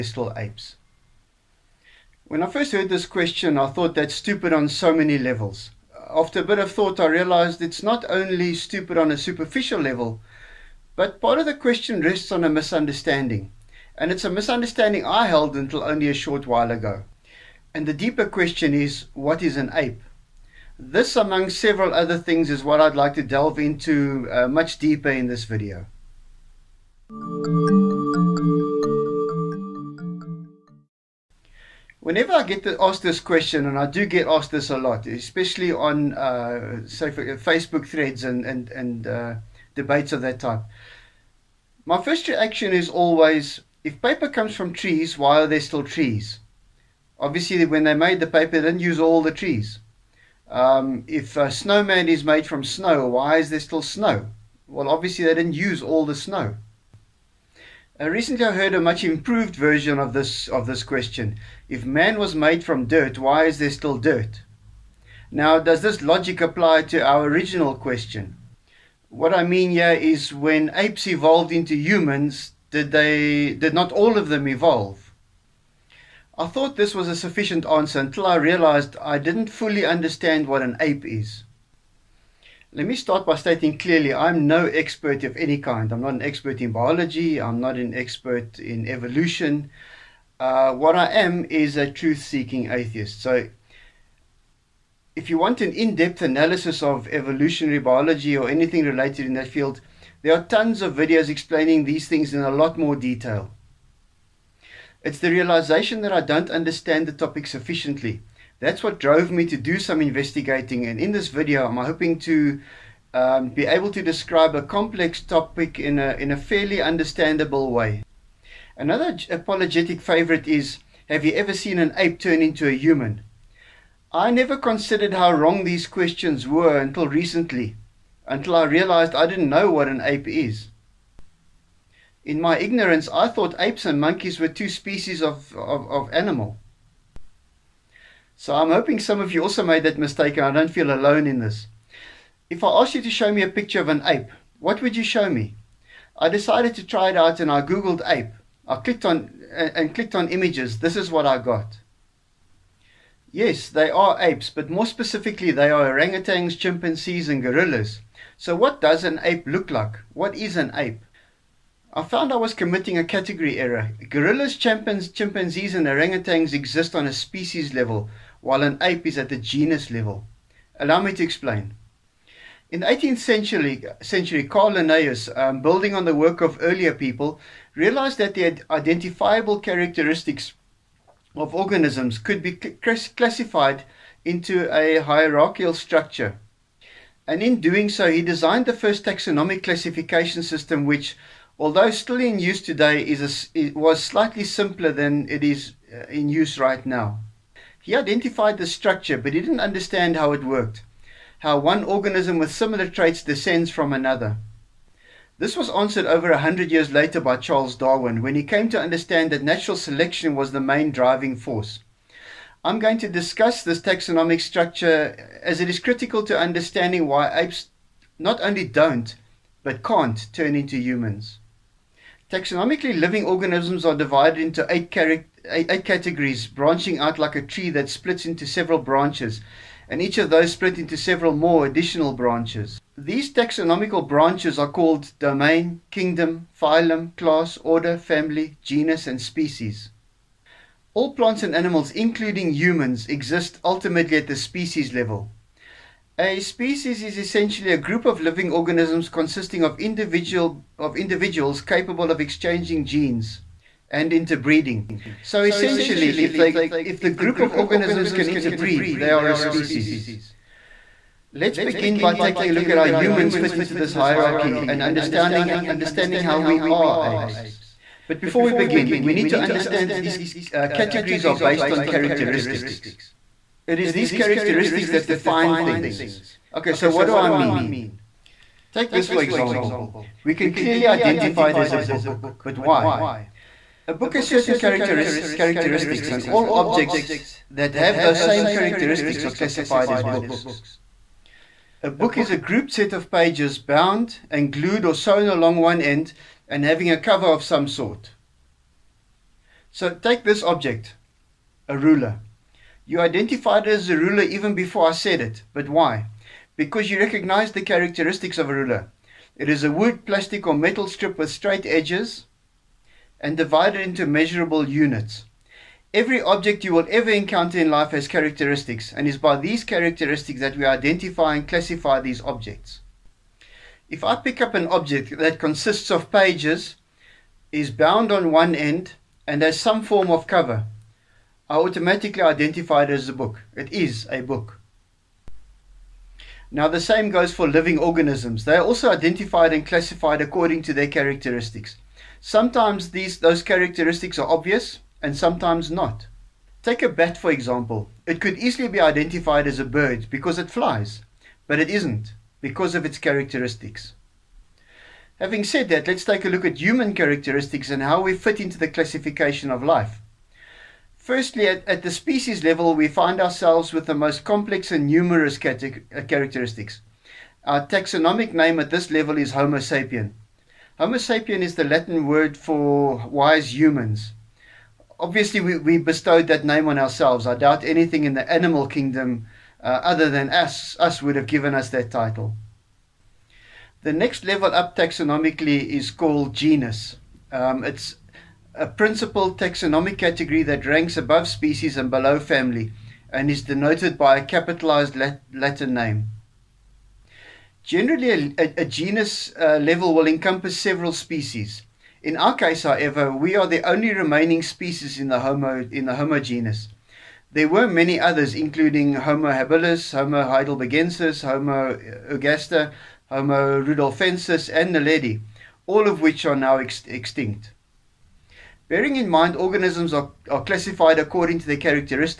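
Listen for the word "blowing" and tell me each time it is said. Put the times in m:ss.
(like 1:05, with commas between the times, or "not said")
not said.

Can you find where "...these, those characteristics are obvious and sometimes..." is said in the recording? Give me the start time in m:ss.
5:42.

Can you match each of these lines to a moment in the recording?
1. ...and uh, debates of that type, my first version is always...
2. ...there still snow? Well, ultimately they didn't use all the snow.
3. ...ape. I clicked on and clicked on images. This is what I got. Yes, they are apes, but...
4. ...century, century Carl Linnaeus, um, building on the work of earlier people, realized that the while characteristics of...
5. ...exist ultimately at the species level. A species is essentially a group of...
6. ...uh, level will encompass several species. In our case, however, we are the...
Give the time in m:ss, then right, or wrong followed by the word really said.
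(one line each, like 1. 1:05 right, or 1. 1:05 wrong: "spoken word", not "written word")
1. 0:38 wrong: "reaction", not "version"
2. 0:53 wrong: "obviously", not "ultimately"
3. 2:28 right
4. 2:53 wrong: "identifiable", not "while"
5. 4:03 right
6. 6:39 right.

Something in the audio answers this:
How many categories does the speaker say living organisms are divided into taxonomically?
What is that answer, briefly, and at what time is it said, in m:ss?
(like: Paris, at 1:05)
8, at 3:44.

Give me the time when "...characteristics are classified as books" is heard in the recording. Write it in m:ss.
4:48.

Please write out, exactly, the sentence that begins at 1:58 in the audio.
Another apologetic favorite is Have you ever seen an ape turn into a human?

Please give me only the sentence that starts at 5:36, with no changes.
Now, the same goes for living organisms.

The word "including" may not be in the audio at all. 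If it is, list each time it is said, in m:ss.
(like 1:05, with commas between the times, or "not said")
4:01, 6:48.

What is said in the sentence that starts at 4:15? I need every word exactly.
So essentially, if they if the group of organisms can interbreed, they are a species.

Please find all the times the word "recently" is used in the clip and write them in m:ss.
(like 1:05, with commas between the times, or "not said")
0:58, 2:07.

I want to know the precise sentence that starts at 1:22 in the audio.
Let me start by stating clearly I'm no expert of any kind.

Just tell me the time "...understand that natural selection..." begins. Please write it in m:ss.
3:28.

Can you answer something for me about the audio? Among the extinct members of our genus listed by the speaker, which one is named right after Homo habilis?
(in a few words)
Homo heidelbergensis.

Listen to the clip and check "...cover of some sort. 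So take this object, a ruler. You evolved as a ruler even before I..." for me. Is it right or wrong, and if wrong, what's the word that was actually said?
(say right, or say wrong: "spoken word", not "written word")
wrong: "identified", not "evolved".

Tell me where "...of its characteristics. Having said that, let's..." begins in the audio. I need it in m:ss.
5:52.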